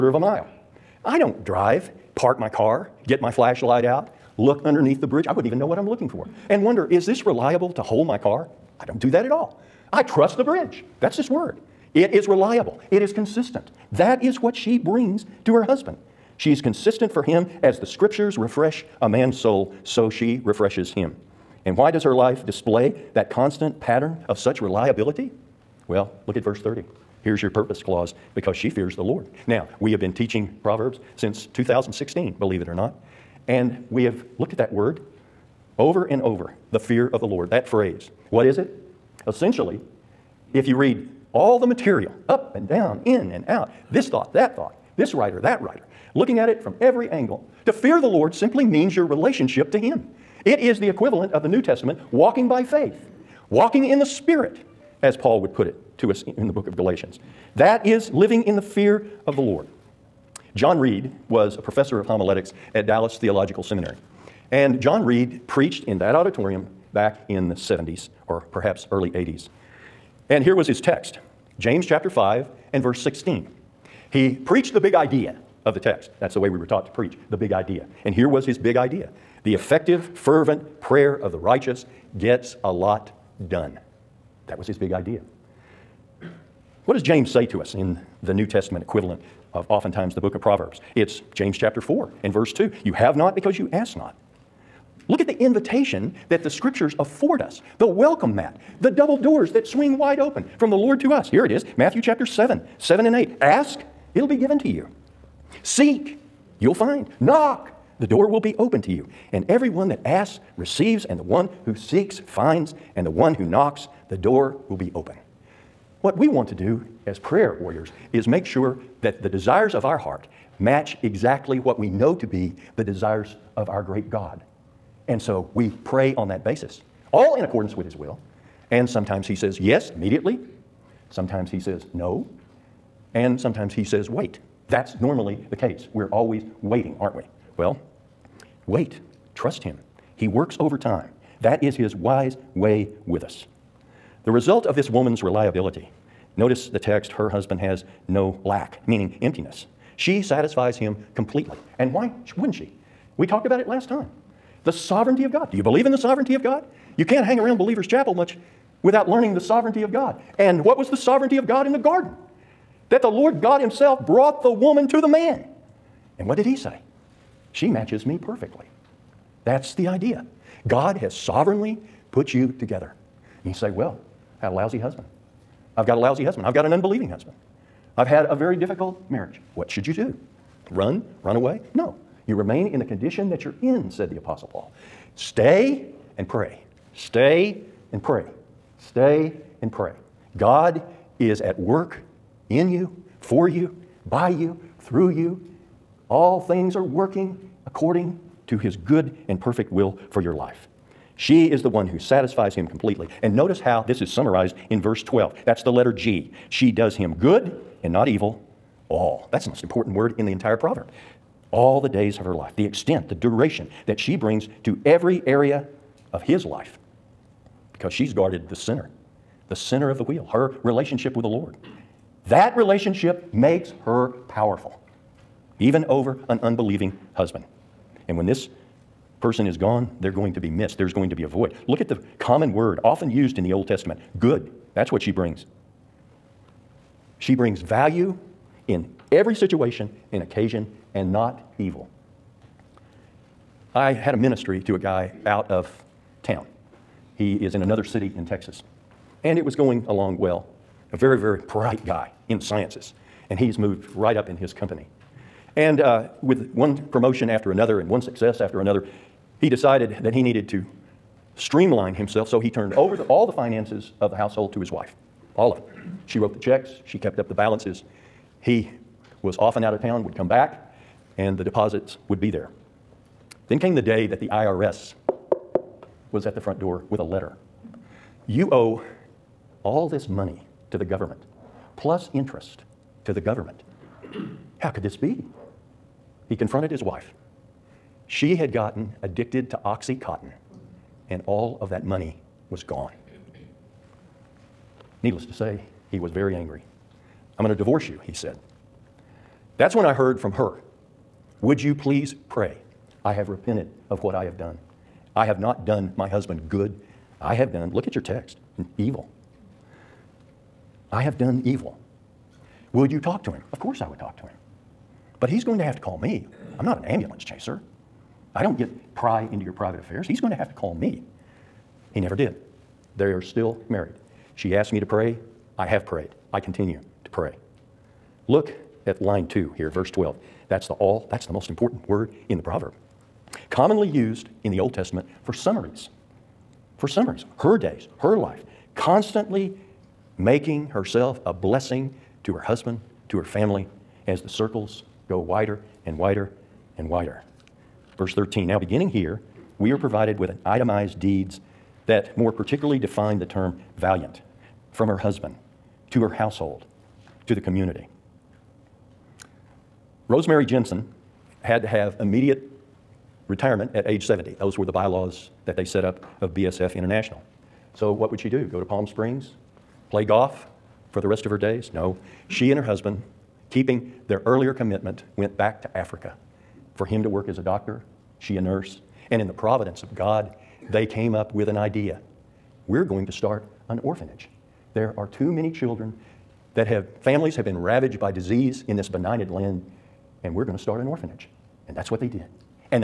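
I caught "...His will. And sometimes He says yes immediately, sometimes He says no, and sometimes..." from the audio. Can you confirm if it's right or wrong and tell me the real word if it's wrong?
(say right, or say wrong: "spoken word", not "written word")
right.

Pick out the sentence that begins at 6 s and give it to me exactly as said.
And wonder, is this reliable to hold my car?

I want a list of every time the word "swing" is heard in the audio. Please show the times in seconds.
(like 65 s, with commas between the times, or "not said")
99 s.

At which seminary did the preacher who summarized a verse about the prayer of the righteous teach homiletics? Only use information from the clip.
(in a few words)
Dallas Theological Seminary.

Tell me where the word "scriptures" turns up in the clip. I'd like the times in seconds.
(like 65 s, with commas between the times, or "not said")
17 s, 96 s.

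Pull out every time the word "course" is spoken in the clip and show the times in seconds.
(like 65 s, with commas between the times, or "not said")
313 s.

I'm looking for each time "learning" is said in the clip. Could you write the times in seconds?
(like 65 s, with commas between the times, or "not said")
159 s.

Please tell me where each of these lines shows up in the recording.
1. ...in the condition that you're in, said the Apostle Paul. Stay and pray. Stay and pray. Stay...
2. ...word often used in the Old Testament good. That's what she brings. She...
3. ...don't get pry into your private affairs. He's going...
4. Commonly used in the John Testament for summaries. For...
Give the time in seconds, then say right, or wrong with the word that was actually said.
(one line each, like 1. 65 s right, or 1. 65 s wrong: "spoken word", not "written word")
1. 182 s right
2. 232 s right
3. 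318 s right
4. 333 s wrong: "Old", not "John".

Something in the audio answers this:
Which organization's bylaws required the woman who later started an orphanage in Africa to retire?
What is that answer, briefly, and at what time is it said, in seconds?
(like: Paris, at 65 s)
BSF International, at 366 s.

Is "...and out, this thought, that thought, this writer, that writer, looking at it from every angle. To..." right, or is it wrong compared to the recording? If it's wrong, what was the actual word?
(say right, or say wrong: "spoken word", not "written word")
right.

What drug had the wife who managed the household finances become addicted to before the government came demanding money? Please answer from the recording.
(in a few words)
OxyContin.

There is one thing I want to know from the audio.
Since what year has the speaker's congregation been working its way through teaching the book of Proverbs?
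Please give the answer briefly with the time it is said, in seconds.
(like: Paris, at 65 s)
2016, at 31 s.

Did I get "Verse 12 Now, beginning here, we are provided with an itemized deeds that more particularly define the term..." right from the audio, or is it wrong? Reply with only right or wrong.
wrong.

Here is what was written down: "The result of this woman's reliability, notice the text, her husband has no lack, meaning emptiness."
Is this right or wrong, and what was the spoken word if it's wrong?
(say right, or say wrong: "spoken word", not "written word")
right.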